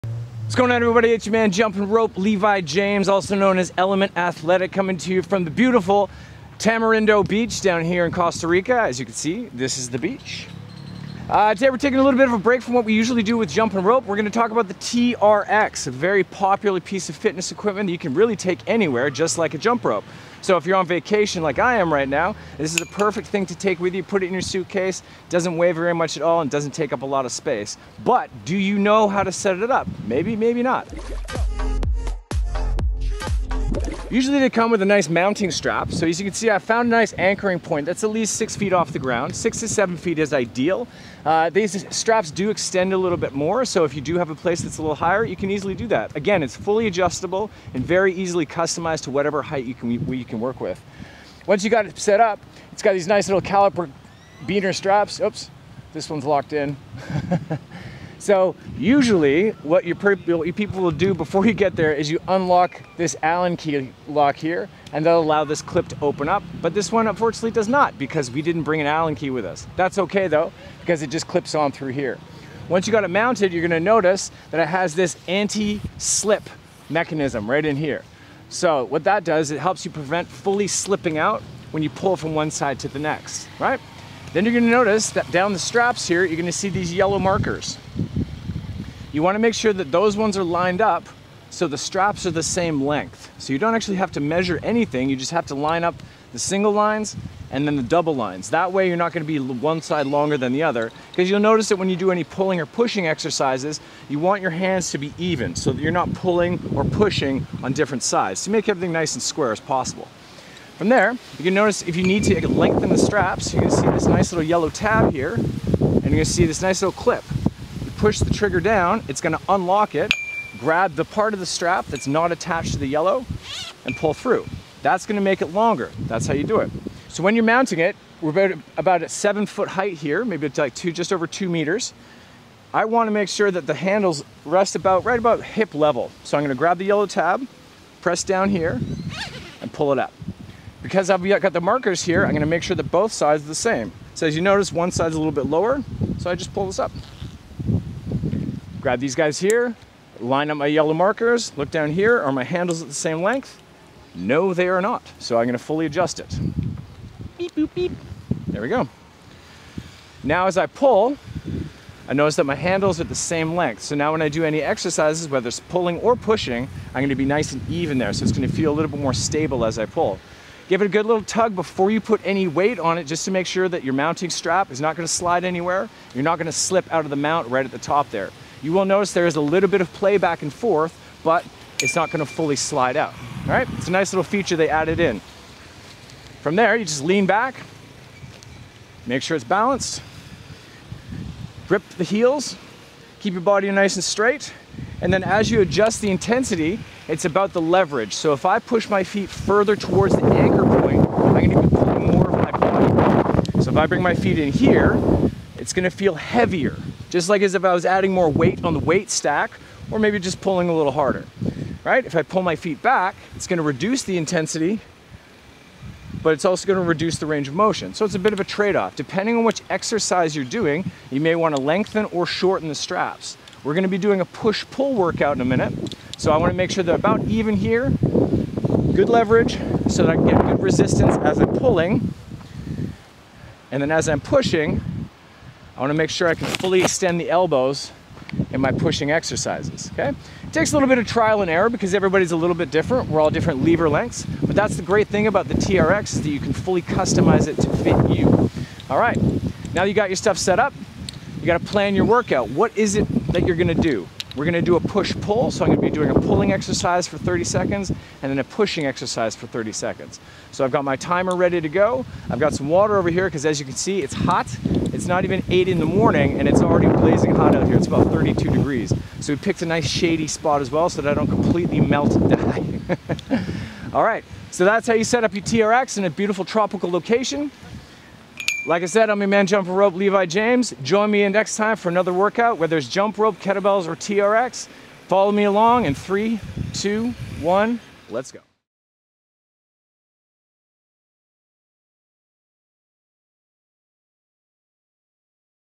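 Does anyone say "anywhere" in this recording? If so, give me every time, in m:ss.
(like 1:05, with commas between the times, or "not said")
0:18, 2:55.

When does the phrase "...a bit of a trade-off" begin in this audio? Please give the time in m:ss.
3:38.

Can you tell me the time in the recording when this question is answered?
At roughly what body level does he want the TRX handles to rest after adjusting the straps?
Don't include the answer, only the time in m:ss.
2:15.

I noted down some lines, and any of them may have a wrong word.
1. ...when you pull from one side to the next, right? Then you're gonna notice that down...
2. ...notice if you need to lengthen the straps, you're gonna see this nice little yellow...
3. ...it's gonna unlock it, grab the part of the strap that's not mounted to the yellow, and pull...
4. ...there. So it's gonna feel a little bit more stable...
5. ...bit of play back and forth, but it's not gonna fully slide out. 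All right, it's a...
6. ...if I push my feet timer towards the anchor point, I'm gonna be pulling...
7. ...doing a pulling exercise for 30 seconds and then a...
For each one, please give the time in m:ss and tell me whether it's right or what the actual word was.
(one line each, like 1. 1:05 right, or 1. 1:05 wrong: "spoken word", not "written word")
1. 1:21 right
2. 1:51 right
3. 1:59 wrong: "attached", not "mounted"
4. 2:47 right
5. 2:59 right
6. 3:18 wrong: "further", not "timer"
7. 4:15 right.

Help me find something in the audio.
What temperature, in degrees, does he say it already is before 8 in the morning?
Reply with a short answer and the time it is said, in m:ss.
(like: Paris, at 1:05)
32, at 4:28.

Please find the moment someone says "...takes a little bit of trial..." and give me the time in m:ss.
4:00.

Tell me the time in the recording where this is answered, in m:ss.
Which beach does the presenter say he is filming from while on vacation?
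0:06.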